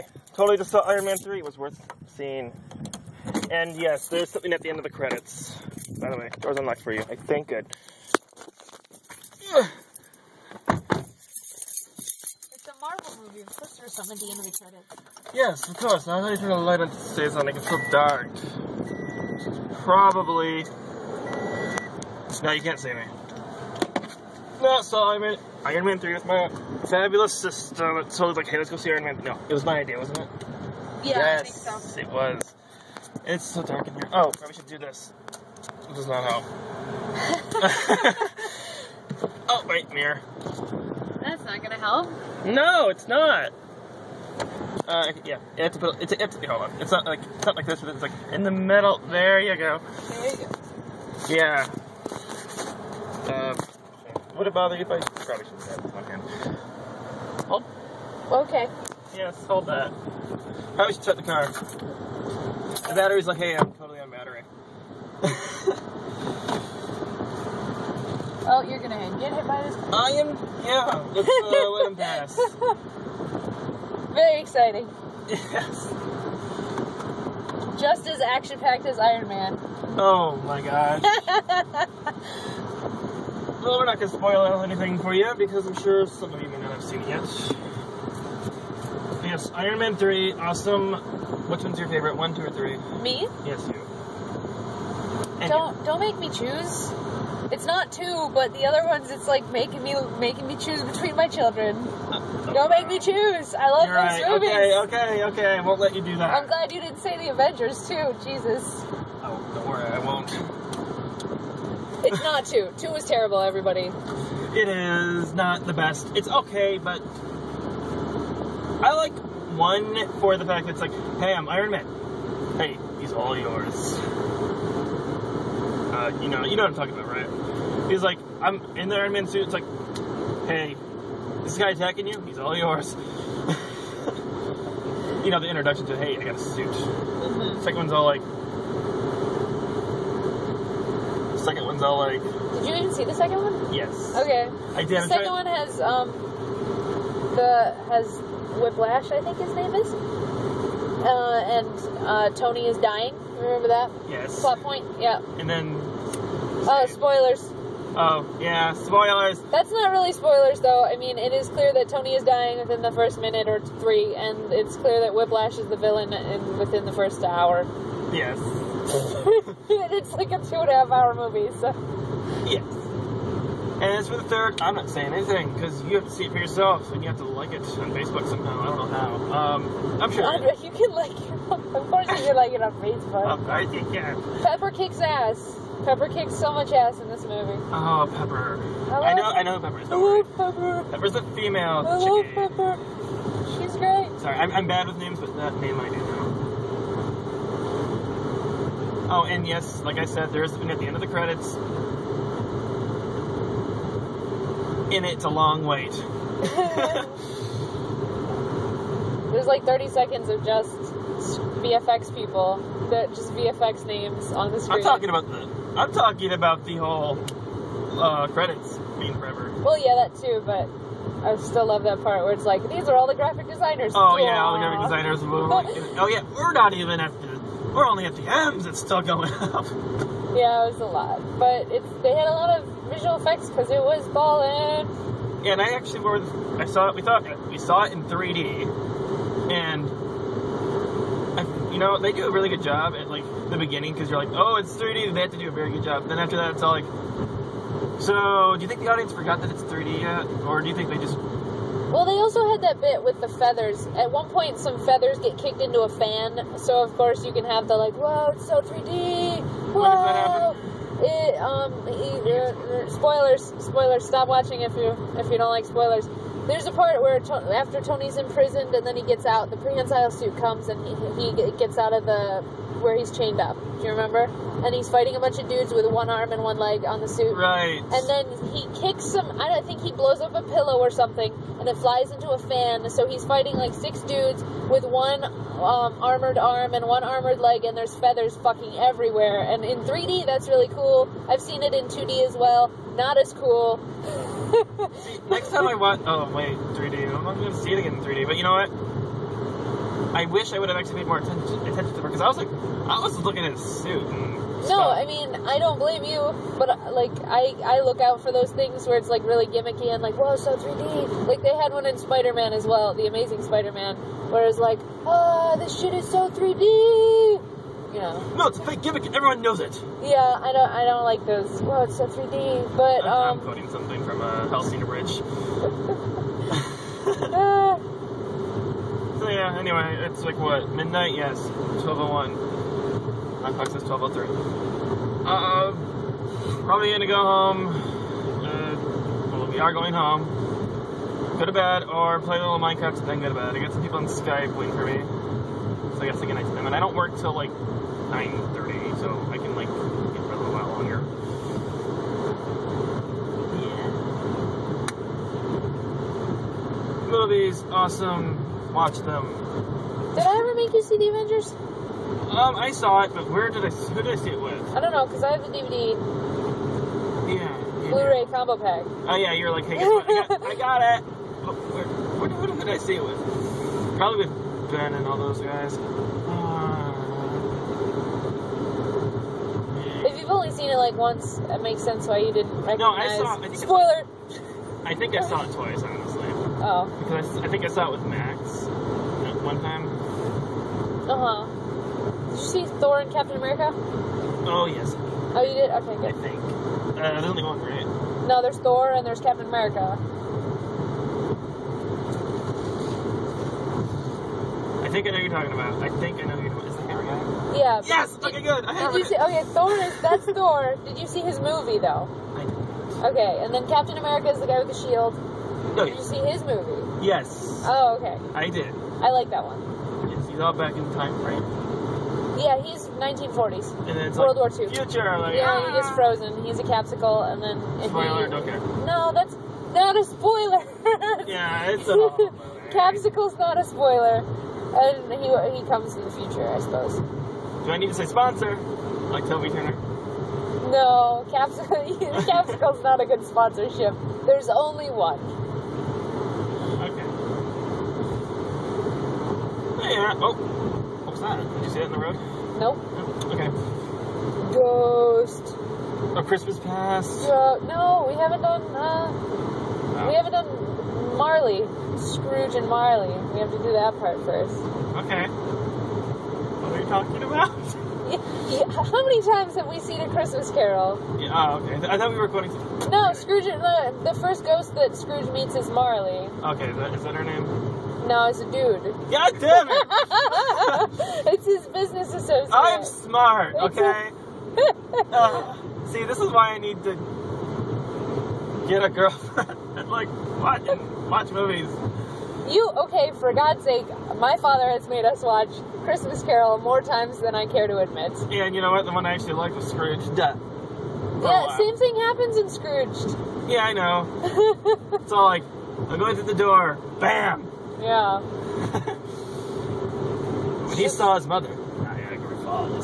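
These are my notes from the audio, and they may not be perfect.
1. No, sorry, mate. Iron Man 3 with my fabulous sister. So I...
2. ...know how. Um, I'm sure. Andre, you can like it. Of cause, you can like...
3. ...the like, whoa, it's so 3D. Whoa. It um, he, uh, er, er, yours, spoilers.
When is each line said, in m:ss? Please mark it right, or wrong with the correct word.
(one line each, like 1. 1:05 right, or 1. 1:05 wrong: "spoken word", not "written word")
1. 0:24 right
2. 2:58 wrong: "course", not "cause"
3. 4:17 wrong: "spoilers", not "yours".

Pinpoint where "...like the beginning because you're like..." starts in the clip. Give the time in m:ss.
4:03.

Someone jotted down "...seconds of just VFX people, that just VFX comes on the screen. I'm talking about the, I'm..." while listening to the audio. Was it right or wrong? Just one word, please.
wrong.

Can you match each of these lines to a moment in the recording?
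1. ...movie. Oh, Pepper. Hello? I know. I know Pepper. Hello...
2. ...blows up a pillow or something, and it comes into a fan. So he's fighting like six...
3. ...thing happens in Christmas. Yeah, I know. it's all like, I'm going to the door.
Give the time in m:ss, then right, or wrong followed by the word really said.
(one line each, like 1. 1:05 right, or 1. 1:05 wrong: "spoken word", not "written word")
1. 3:07 right
2. 4:39 wrong: "flies", not "comes"
3. 8:21 wrong: "Scrooge", not "Christmas".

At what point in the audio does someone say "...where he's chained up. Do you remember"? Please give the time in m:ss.
4:32.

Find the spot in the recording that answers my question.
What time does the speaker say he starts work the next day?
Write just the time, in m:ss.
5:47.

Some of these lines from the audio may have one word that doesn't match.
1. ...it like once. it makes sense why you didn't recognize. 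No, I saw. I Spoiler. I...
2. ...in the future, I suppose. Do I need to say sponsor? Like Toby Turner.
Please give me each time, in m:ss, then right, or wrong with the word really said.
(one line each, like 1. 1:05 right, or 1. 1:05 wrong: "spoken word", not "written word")
1. 6:20 right
2. 7:15 right.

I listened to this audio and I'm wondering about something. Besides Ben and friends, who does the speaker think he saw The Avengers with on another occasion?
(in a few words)
Max.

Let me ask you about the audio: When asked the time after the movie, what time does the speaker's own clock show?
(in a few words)
12:03.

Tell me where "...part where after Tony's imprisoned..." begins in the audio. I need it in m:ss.
4:26.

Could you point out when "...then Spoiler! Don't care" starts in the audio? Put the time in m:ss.
7:07.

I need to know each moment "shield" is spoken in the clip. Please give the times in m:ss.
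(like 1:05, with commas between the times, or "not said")
6:54.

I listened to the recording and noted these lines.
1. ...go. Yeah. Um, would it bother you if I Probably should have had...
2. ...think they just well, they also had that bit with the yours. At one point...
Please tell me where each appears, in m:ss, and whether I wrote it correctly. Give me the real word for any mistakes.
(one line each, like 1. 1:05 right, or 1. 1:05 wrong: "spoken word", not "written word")
1. 0:50 right
2. 4:10 wrong: "feathers", not "yours".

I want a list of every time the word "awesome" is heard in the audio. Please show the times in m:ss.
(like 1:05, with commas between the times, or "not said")
1:30, 5:57.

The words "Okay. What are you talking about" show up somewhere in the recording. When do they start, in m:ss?
7:45.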